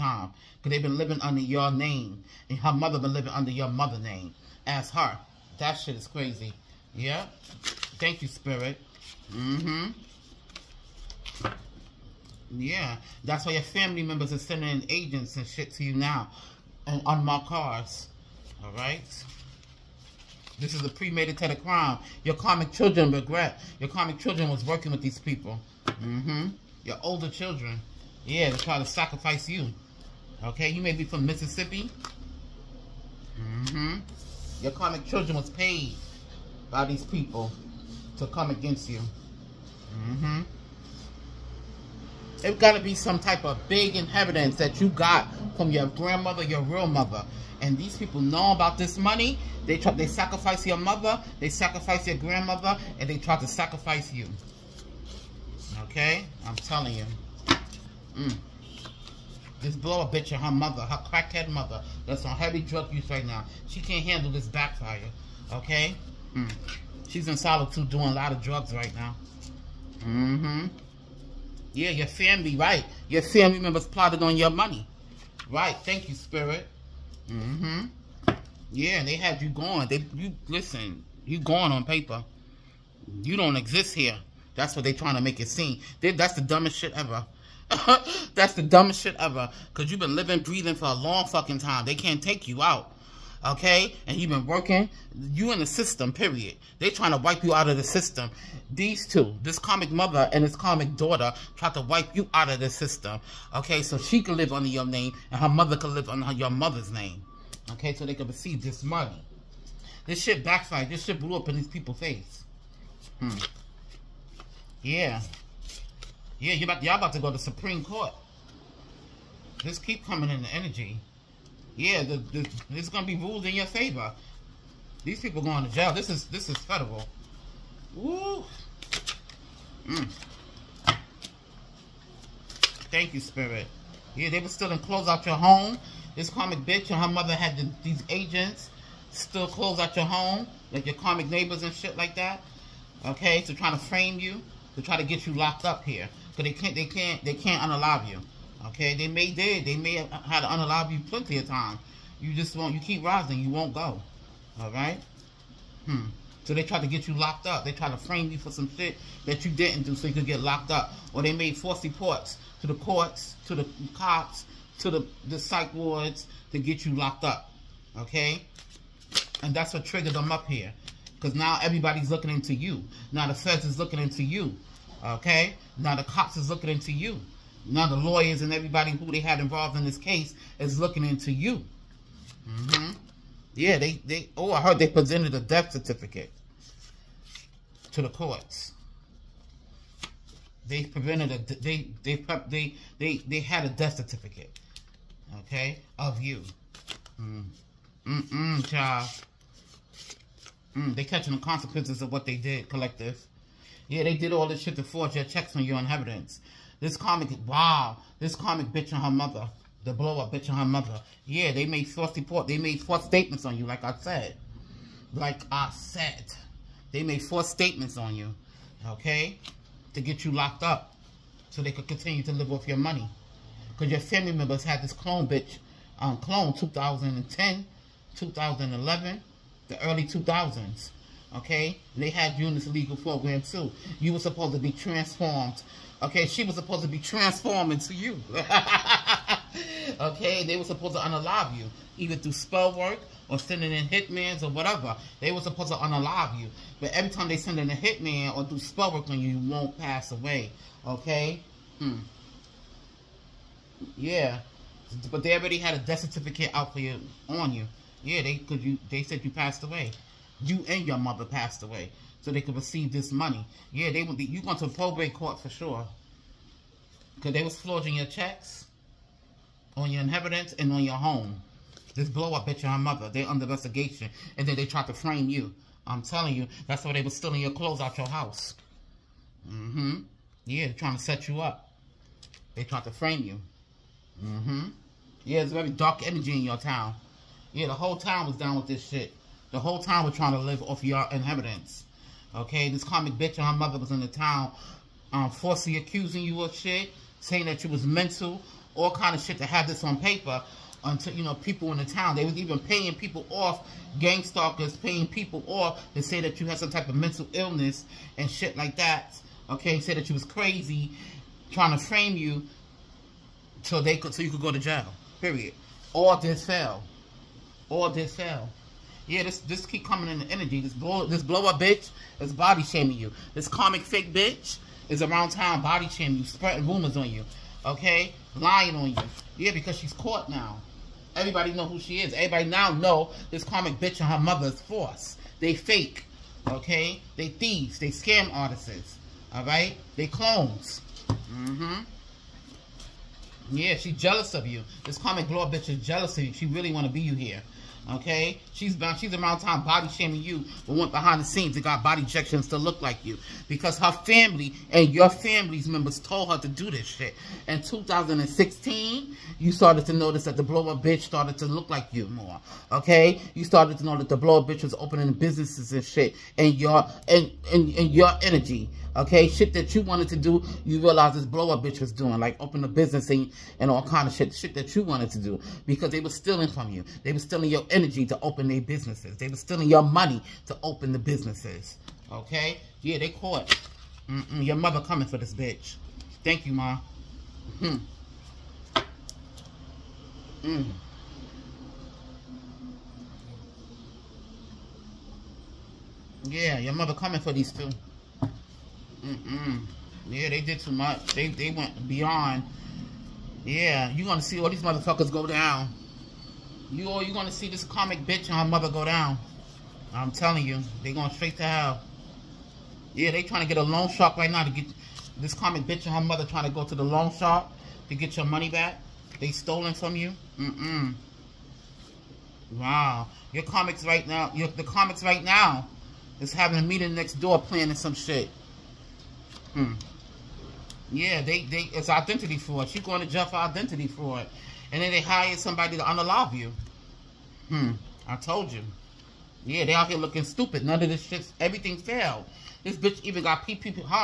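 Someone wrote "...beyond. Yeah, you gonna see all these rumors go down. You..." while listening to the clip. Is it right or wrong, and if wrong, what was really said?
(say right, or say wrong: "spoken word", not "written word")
wrong: "motherfuckers", not "rumors".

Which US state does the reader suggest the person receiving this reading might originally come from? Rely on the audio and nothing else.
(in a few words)
Mississippi.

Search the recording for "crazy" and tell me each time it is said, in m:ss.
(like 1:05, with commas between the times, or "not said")
0:06, 5:10.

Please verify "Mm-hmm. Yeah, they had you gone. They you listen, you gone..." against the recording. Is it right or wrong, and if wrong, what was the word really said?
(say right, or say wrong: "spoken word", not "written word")
right.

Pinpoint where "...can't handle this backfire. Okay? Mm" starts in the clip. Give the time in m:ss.
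1:03.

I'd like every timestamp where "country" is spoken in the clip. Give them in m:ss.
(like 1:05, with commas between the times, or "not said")
not said.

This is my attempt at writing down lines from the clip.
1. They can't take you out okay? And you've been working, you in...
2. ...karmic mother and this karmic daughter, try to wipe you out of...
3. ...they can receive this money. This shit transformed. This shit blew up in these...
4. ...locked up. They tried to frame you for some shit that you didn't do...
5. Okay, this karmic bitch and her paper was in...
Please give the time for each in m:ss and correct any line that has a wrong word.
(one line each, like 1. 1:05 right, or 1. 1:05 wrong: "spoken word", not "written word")
1. 1:31 right
2. 1:39 right
3. 1:48 wrong: "backfired", not "transformed"
4. 2:37 right
5. 4:52 wrong: "mother", not "paper".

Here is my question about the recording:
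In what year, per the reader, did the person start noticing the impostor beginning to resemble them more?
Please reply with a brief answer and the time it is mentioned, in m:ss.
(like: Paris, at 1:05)
2016, at 5:57.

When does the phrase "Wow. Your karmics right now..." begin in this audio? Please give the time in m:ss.
7:02.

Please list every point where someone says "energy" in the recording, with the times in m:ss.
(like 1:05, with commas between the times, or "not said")
2:00, 4:46, 5:20, 6:08, 6:17.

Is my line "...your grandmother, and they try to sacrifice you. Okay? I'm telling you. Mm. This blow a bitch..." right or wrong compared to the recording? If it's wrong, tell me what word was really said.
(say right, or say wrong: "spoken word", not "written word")
right.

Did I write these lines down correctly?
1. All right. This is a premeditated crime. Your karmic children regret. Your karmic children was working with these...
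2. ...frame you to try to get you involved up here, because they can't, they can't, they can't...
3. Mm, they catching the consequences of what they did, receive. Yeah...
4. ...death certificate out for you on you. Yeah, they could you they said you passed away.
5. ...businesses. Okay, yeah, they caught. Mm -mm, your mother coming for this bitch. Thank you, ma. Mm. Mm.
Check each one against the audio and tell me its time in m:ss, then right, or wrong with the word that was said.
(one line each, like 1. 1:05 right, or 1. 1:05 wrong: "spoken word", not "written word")
1. 0:18 right
2. 2:23 wrong: "locked", not "involved"
3. 3:20 wrong: "collective", not "receive"
4. 4:15 right
5. 6:20 right.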